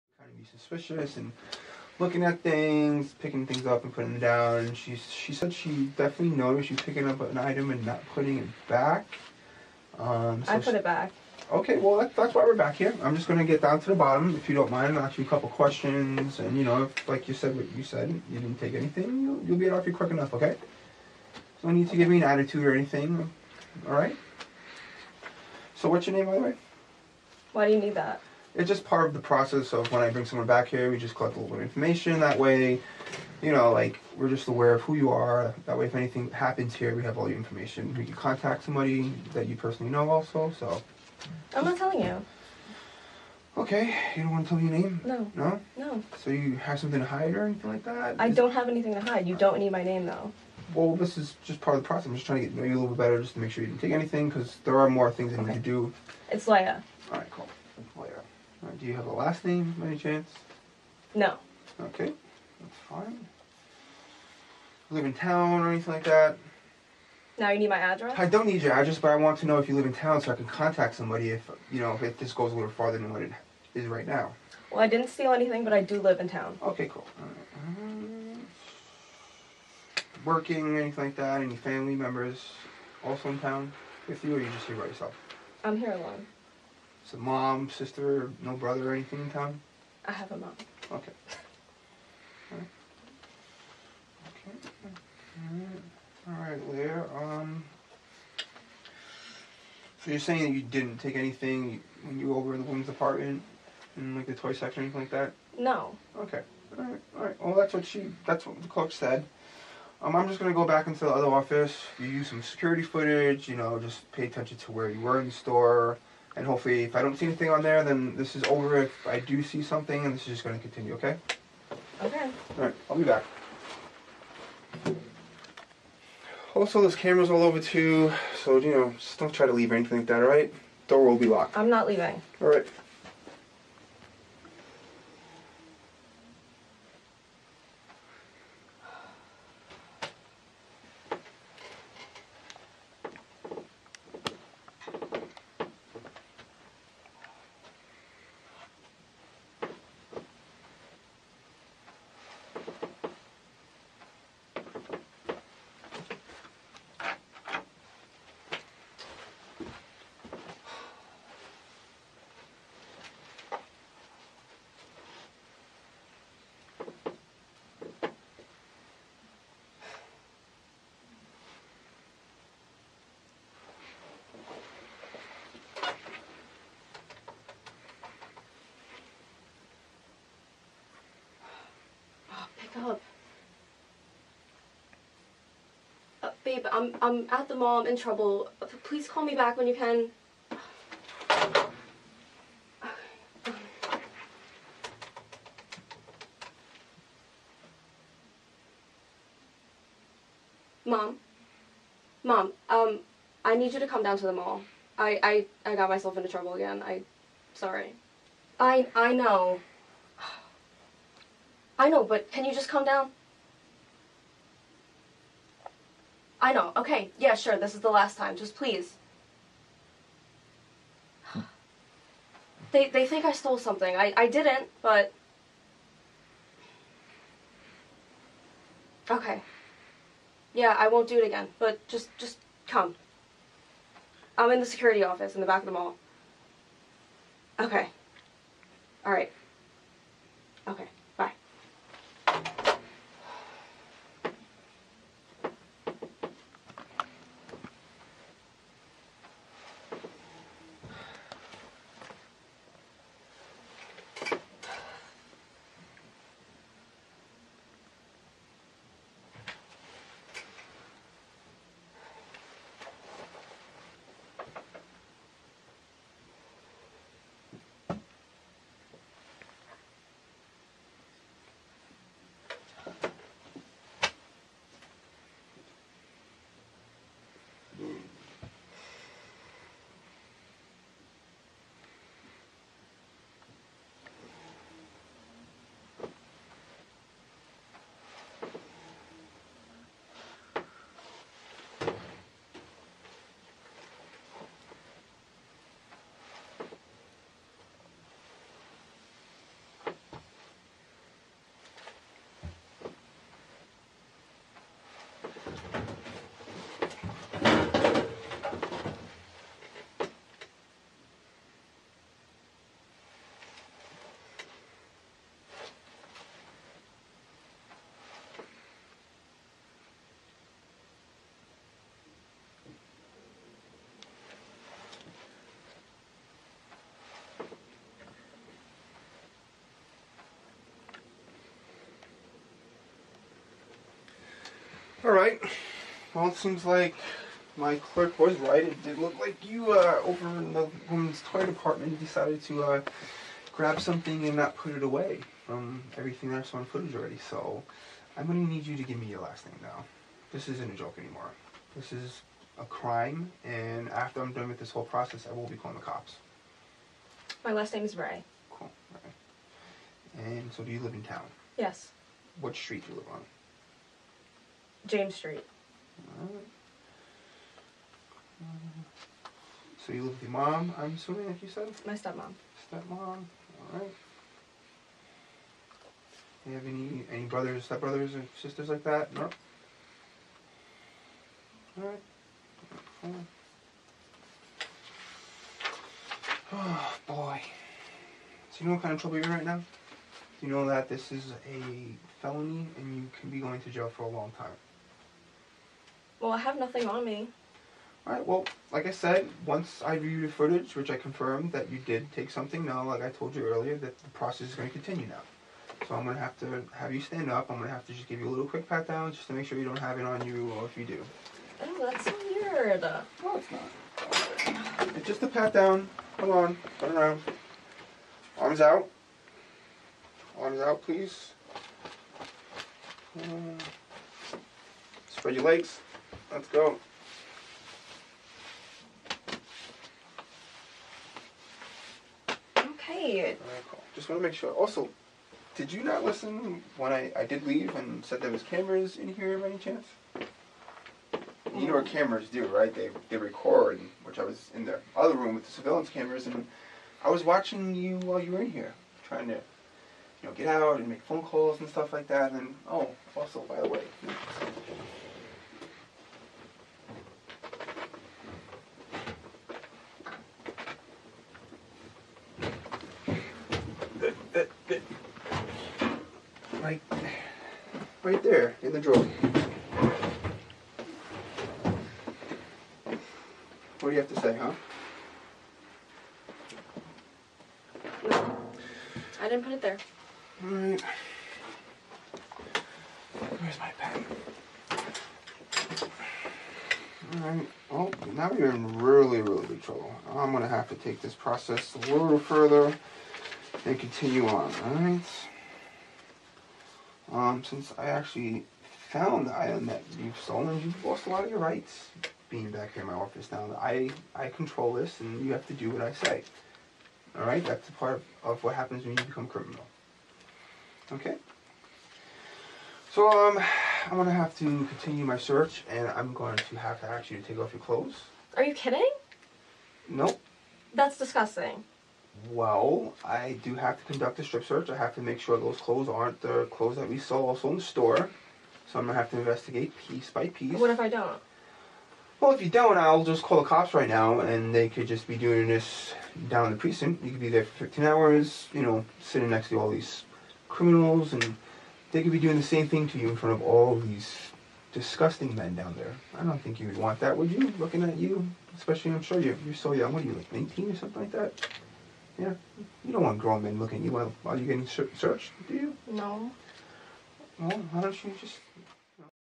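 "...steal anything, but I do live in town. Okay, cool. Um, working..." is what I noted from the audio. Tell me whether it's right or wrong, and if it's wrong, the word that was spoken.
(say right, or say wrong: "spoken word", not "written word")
right.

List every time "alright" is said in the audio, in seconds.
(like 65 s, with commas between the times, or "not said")
239 s, 335 s, 373 s, 381 s, 398 s, 480 s, 487 s, 494 s.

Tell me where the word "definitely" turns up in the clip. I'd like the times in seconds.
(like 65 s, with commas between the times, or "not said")
5 s.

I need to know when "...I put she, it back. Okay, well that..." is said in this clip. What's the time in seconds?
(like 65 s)
10 s.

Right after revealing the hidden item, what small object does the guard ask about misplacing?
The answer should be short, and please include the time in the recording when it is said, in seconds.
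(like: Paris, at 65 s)
pen, at 483 s.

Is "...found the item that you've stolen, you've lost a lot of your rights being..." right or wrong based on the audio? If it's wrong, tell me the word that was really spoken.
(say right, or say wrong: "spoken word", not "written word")
right.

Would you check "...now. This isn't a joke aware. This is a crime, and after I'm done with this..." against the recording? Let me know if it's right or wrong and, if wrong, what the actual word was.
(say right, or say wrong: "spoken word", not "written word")
wrong: "anymore", not "aware".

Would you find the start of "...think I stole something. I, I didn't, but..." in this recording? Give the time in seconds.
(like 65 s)
223 s.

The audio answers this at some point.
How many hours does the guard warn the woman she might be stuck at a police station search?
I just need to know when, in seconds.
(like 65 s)
537 s.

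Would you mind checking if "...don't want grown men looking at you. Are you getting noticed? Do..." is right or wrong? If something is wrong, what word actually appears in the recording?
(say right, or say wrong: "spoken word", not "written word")
wrong: "searched", not "noticed".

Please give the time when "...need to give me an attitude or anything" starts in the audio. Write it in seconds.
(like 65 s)
21 s.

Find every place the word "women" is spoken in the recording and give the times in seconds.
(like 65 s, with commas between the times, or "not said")
102 s, 340 s.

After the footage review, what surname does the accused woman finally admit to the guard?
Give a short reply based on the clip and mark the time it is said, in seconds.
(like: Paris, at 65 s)
Rae, at 357 s.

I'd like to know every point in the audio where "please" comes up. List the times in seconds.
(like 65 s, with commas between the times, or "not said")
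188 s, 218 s, 420 s.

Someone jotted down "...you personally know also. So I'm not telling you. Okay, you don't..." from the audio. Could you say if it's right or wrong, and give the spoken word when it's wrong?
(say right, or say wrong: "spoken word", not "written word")
right.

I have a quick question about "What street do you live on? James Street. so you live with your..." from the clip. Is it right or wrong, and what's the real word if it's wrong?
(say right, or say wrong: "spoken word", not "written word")
right.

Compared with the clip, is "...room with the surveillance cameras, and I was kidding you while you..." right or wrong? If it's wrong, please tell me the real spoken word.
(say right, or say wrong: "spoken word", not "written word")
wrong: "watching", not "kidding".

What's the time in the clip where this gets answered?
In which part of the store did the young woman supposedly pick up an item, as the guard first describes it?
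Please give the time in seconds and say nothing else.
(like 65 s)
104 s.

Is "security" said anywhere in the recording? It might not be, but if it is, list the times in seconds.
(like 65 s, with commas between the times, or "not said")
112 s, 234 s.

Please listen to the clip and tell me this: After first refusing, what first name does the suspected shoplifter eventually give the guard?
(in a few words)
Leia.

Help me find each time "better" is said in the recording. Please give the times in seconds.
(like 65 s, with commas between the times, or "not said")
52 s.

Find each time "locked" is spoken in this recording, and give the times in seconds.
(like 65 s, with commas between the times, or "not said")
131 s.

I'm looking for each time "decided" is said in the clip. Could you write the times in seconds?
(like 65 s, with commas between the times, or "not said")
341 s.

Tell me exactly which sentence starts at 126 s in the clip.
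Also, this camera's all over too, so, you know, just don't try to leave or anything like that, all right?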